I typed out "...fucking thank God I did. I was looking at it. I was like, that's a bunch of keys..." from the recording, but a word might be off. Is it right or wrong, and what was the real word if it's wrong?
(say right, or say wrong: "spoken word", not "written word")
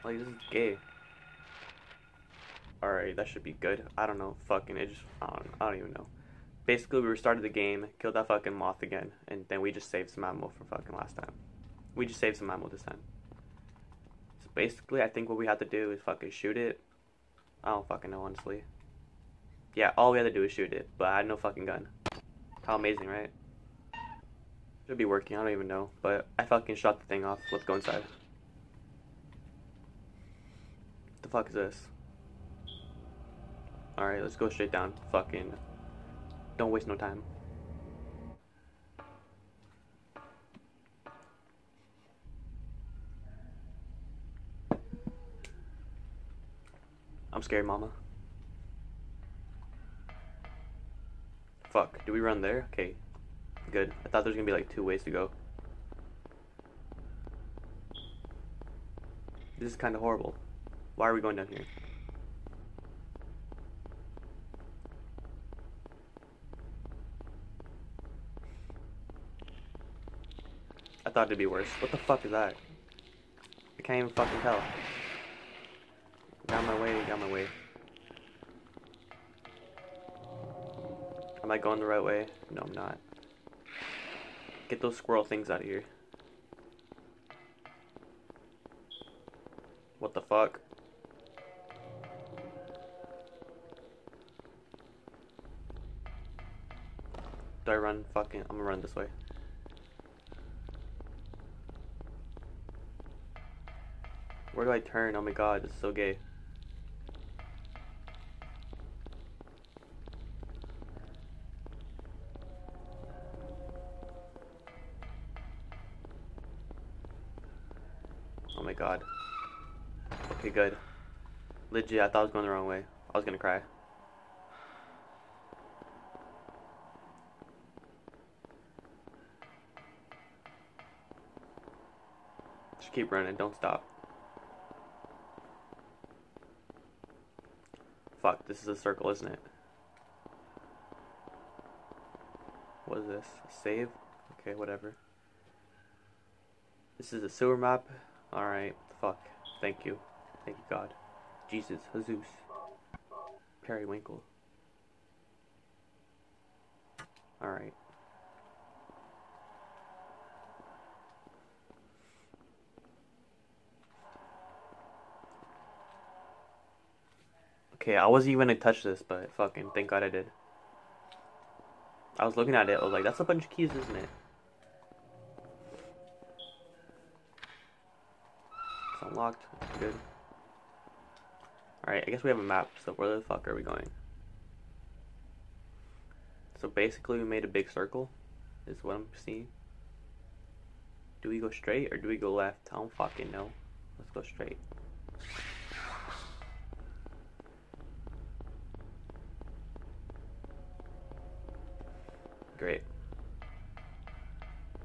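right.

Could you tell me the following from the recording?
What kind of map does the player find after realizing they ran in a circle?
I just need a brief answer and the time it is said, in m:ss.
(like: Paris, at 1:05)
Sewer map, at 2:27.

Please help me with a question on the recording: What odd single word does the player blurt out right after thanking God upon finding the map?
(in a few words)
Periwinkle.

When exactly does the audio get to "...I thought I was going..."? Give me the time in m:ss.
2:01.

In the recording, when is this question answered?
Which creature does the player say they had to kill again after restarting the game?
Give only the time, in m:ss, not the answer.
0:08.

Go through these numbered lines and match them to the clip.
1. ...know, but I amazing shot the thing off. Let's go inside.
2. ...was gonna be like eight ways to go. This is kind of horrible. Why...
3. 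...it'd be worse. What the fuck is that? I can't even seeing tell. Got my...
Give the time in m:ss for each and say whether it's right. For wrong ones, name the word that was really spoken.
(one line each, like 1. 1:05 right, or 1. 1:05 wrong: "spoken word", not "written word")
1. 0:25 wrong: "fucking", not "amazing"
2. 0:54 wrong: "two", not "eight"
3. 1:11 wrong: "fucking", not "seeing".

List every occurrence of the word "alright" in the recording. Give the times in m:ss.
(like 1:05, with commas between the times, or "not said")
0:02, 0:33, 2:28, 2:37, 3:01.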